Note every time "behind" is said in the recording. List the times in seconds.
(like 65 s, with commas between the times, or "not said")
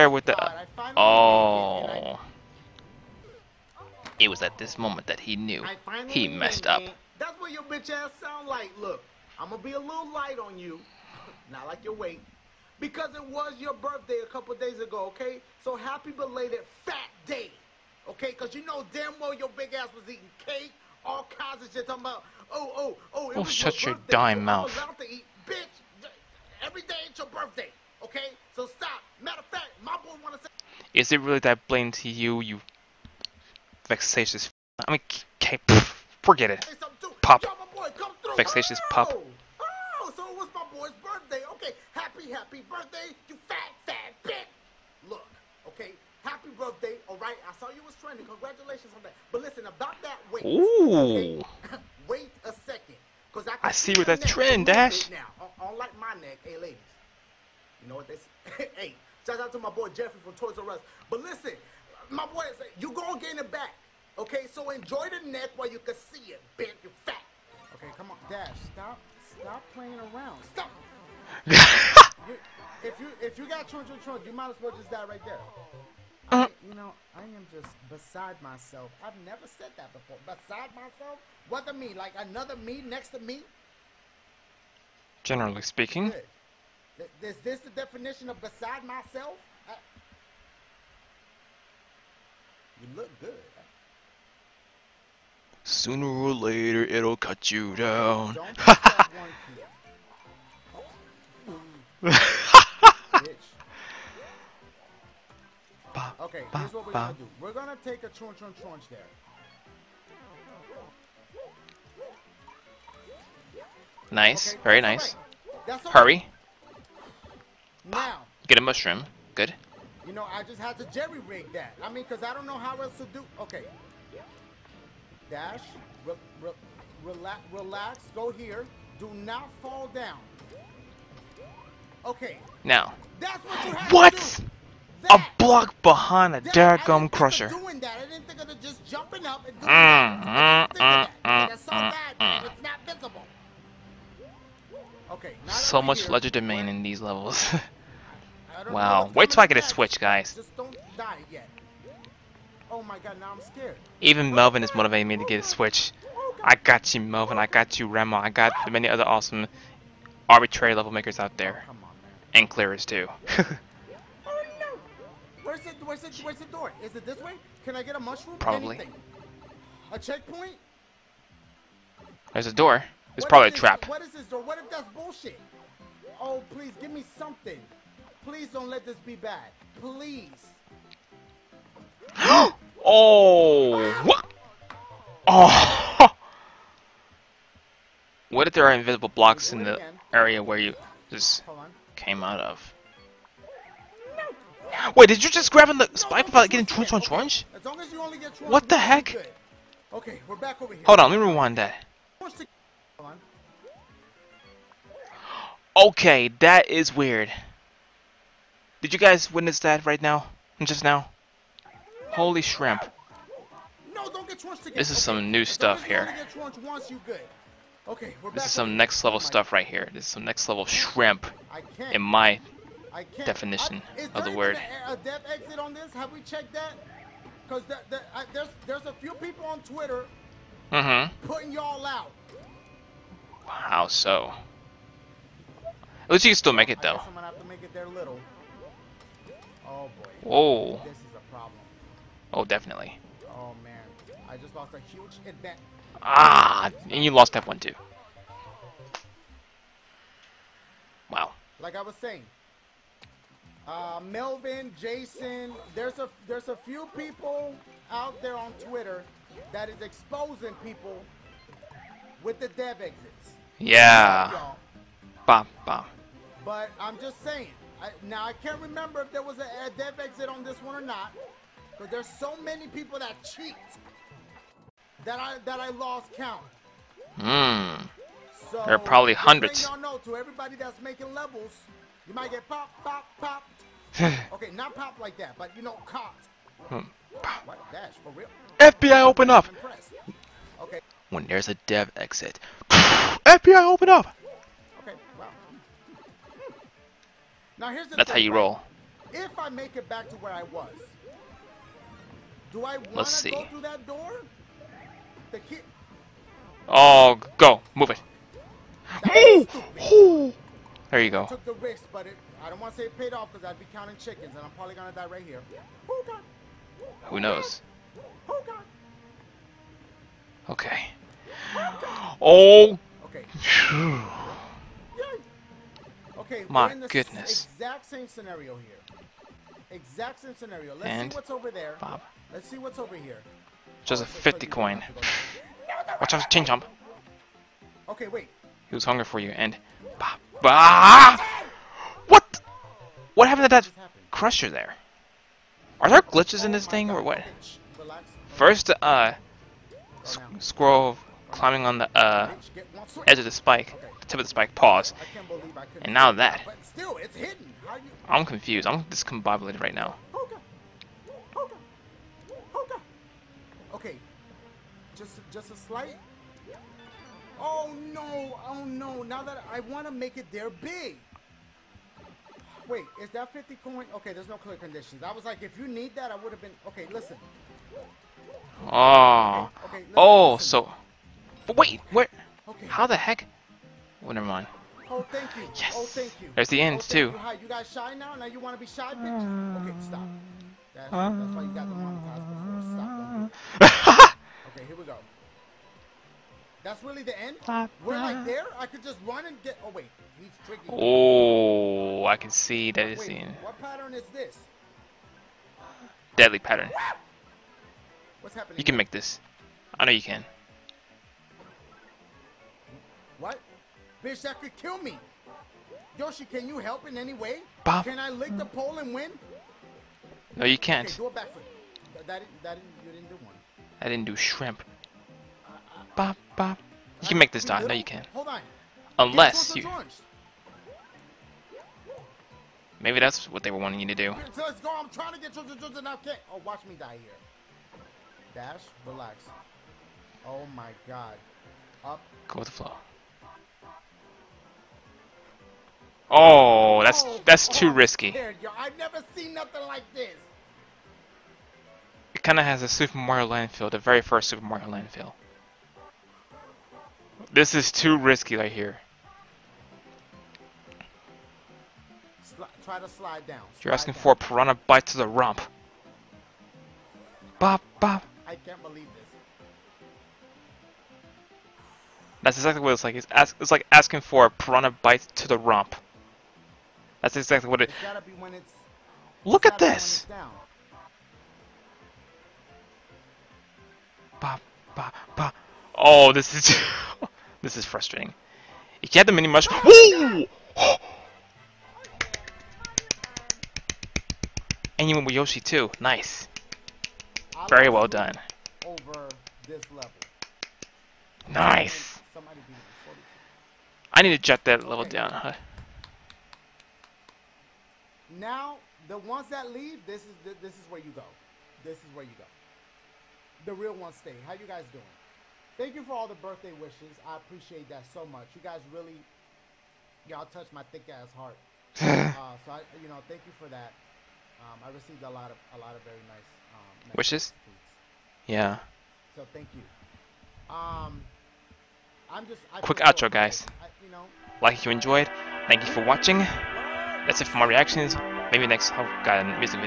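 135 s.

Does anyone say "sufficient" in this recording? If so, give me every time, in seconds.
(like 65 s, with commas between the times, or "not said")
not said.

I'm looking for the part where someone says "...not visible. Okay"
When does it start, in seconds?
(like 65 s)
142 s.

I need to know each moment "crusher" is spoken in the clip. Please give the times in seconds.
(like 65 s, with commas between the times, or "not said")
137 s, 344 s.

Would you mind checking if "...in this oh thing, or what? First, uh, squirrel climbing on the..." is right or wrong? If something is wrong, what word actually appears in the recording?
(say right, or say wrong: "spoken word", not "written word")
right.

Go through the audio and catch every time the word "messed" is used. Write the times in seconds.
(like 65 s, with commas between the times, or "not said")
6 s.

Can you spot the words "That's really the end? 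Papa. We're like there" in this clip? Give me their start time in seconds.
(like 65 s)
396 s.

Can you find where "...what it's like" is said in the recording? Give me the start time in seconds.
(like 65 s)
472 s.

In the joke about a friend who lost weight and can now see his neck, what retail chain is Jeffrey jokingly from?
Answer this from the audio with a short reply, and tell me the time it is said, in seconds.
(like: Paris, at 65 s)
Toys R Us, at 60 s.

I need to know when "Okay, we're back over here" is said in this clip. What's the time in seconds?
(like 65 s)
199 s.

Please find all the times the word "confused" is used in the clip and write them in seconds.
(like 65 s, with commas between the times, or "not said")
358 s.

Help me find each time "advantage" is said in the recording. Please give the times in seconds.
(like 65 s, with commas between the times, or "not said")
245 s.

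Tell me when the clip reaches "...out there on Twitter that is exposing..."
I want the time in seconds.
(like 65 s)
257 s.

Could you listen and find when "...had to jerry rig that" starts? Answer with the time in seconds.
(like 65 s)
120 s.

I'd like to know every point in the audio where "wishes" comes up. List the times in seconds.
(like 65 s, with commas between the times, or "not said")
516 s, 526 s.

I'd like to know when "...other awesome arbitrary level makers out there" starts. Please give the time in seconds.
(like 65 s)
158 s.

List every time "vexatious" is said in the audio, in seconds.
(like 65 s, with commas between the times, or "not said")
33 s, 38 s.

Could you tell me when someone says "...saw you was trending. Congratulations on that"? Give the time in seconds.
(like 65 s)
47 s.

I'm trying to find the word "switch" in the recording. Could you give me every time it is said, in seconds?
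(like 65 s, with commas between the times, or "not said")
149 s, 155 s.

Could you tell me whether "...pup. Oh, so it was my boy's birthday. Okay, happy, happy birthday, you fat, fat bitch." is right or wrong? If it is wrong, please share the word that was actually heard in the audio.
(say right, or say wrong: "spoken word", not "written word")
right.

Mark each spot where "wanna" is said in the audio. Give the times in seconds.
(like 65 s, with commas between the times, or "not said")
30 s, 302 s.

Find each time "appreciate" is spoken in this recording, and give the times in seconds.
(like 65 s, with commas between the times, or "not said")
517 s.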